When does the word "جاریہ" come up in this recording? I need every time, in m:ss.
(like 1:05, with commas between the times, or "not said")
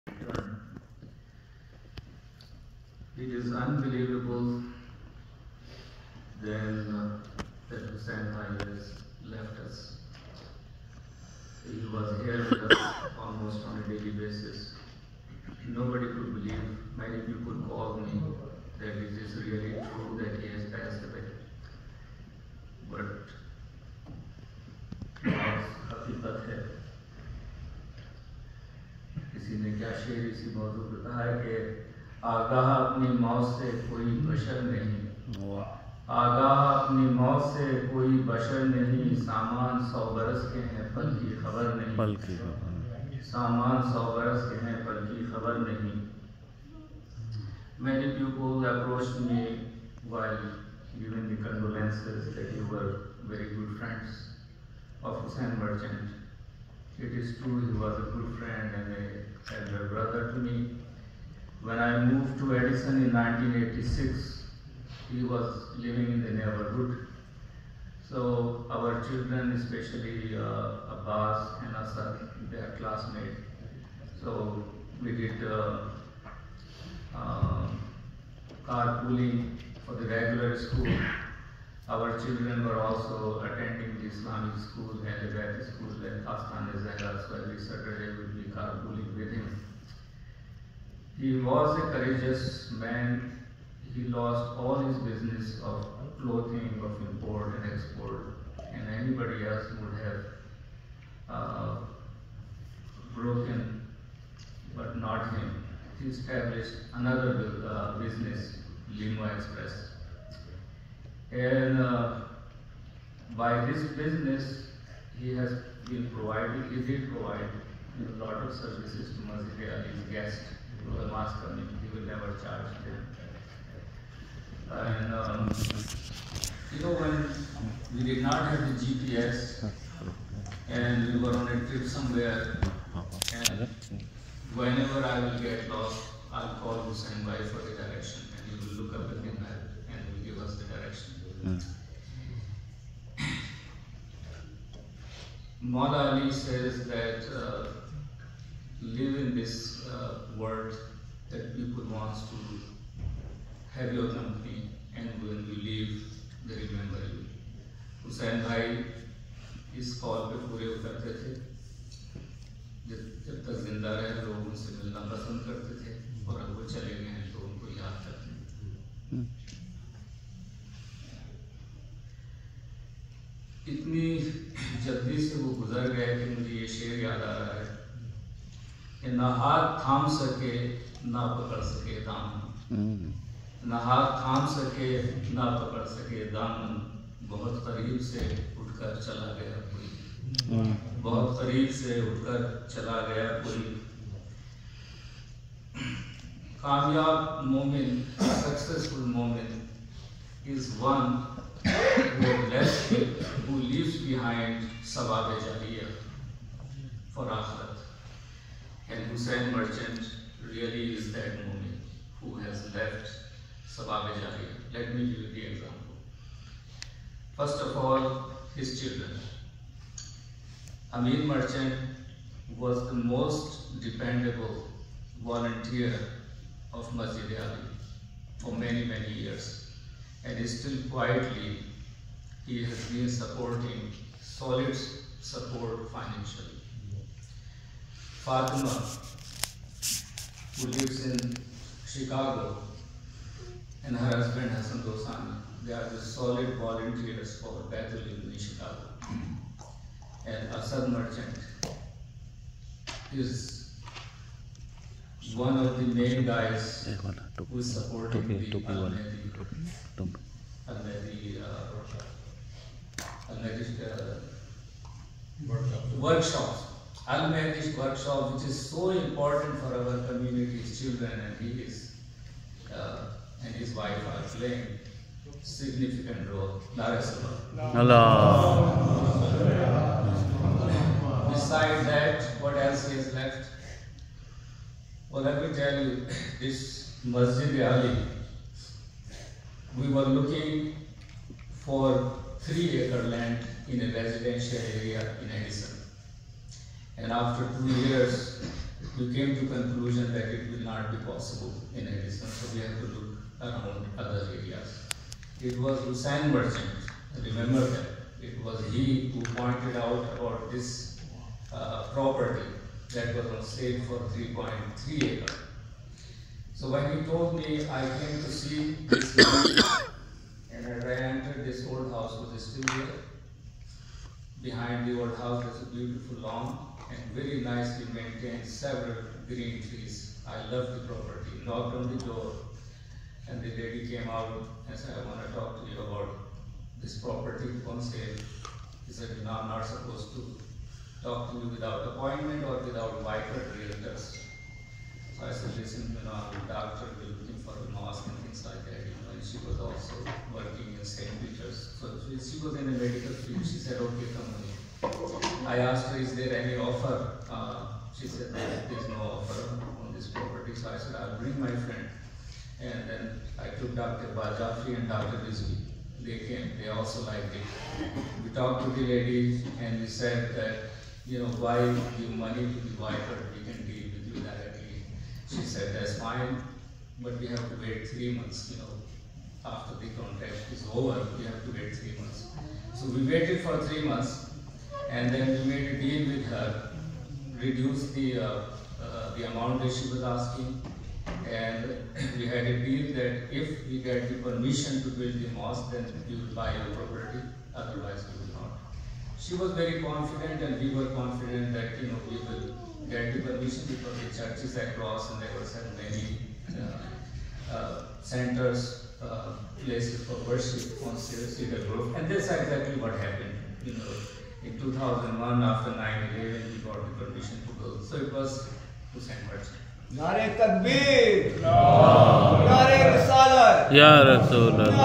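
3:25.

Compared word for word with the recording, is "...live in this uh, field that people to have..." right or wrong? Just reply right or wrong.
wrong.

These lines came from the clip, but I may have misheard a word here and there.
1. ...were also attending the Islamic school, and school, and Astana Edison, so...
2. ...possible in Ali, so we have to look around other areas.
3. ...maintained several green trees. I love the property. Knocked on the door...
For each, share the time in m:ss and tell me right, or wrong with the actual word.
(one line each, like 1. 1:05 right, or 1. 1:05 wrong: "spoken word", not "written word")
1. 1:22 wrong: "Zahra", not "Edison"
2. 5:01 wrong: "Edison", not "Ali"
3. 5:27 right.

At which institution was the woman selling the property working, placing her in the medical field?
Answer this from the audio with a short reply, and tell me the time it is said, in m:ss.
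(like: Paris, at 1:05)
St. Peter's, at 5:50.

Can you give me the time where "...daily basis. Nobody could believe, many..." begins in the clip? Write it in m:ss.
0:13.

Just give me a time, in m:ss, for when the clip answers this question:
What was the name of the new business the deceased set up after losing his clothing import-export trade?
1:48.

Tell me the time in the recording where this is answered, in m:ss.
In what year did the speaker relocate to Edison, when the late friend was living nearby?
1:03.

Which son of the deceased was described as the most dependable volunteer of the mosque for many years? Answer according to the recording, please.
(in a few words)
Amin Merchant.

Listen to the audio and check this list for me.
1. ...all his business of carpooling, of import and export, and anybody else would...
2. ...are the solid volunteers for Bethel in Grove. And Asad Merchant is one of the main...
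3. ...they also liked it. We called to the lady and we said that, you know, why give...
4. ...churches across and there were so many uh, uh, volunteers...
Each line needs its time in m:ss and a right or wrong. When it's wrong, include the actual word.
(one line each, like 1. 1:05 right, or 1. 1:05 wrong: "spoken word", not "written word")
1. 1:34 wrong: "clothing", not "carpooling"
2. 4:05 wrong: "Chicago", not "Grove"
3. 6:06 wrong: "talked", not "called"
4. 6:44 wrong: "centers", not "volunteers".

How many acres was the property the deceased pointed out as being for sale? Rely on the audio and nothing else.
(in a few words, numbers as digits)
3.3.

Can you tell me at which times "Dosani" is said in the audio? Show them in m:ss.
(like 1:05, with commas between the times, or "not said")
4:04.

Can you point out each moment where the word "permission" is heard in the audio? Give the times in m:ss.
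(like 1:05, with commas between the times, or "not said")
6:34, 6:43, 6:57.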